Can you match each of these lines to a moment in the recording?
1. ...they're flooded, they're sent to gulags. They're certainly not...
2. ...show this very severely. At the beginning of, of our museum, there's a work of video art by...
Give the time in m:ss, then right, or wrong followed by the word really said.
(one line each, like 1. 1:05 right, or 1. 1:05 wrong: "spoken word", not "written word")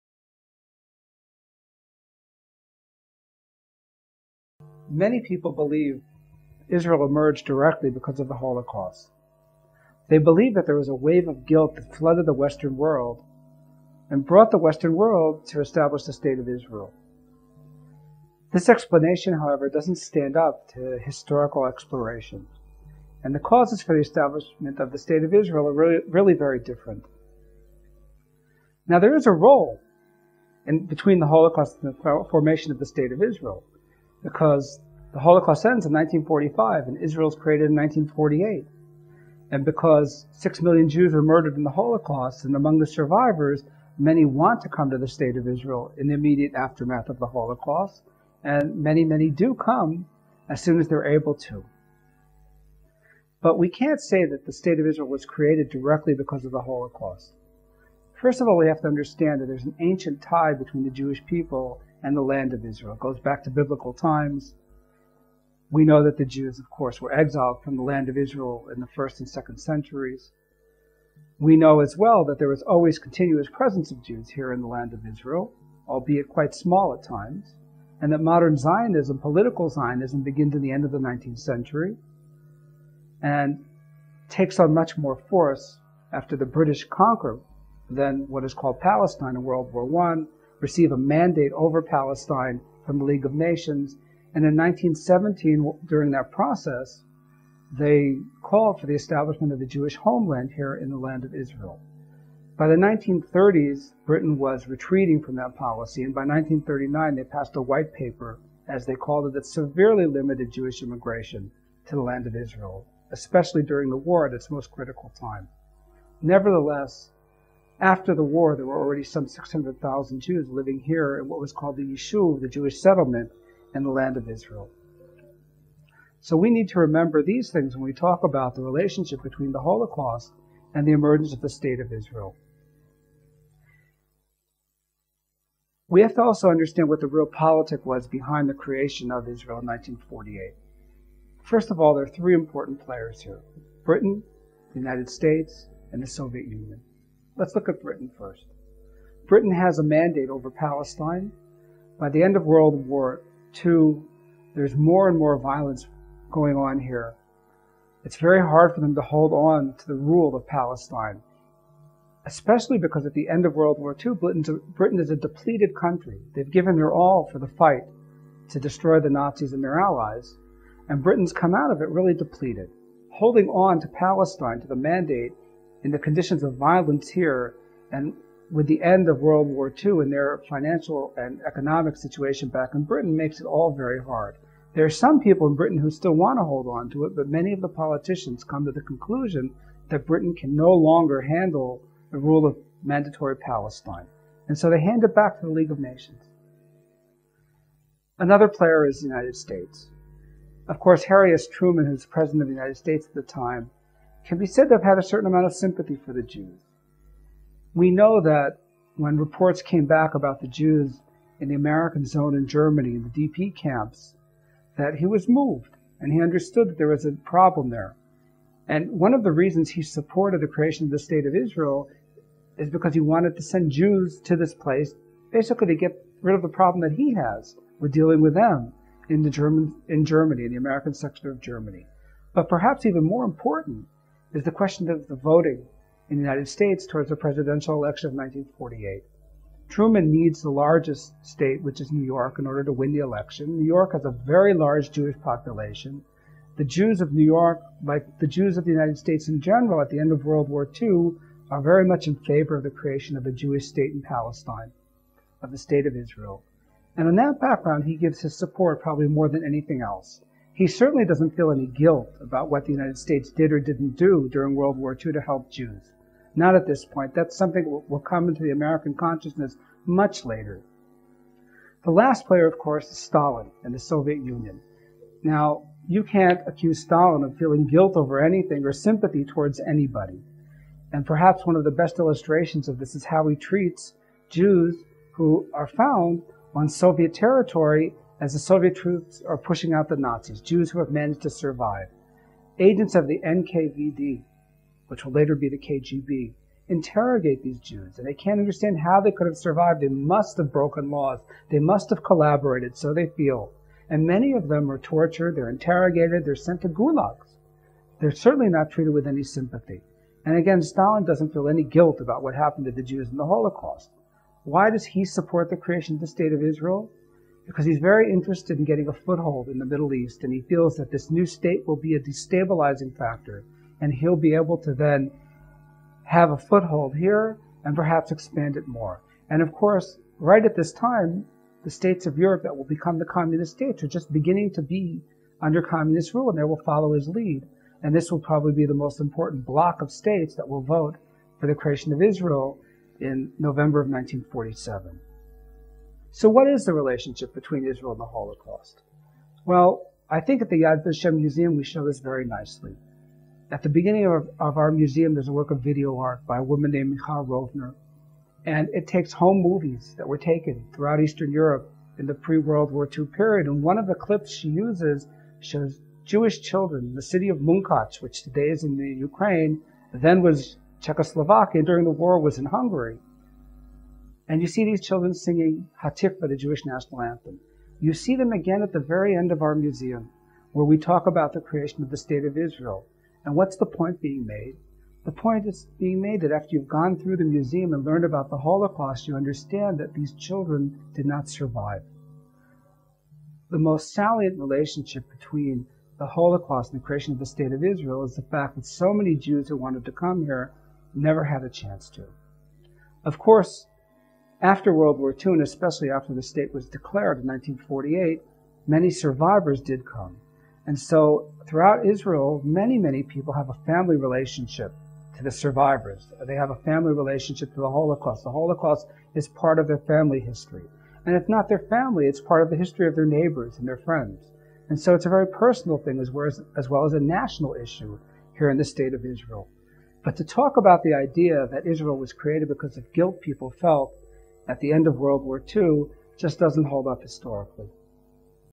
1. 5:05 wrong: "interrogated", not "flooded"
2. 5:51 wrong: "nicely", not "severely".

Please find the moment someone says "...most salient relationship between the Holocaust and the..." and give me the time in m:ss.
6:33.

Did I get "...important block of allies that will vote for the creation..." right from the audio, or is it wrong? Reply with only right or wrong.
wrong.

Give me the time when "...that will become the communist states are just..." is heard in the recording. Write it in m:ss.
5:32.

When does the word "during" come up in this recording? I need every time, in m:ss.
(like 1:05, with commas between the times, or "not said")
1:35, 1:53, 4:24, 6:11.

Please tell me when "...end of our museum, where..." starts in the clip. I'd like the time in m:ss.
6:19.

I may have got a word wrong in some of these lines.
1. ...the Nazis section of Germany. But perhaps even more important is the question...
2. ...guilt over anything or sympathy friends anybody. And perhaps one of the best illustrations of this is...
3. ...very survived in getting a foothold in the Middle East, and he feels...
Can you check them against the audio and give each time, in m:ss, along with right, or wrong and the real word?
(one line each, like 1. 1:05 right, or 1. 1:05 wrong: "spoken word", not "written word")
1. 3:50 wrong: "American", not "Nazis"
2. 4:37 wrong: "towards", not "friends"
3. 5:17 wrong: "interested", not "survived".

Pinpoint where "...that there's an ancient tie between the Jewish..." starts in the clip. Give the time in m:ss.
0:59.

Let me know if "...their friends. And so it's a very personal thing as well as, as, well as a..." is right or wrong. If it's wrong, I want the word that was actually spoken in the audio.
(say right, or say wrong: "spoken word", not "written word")
right.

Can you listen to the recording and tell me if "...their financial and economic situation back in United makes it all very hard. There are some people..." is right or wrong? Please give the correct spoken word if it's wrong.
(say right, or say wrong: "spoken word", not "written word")
wrong: "Britain", not "United".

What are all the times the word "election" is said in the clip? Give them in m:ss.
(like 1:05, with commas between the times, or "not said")
3:57, 4:02.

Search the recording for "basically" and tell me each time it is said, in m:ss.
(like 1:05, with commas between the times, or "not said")
3:45.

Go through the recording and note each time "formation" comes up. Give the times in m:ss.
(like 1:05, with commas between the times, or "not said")
0:32.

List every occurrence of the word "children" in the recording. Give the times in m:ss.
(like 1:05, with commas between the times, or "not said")
6:06, 6:14, 6:30.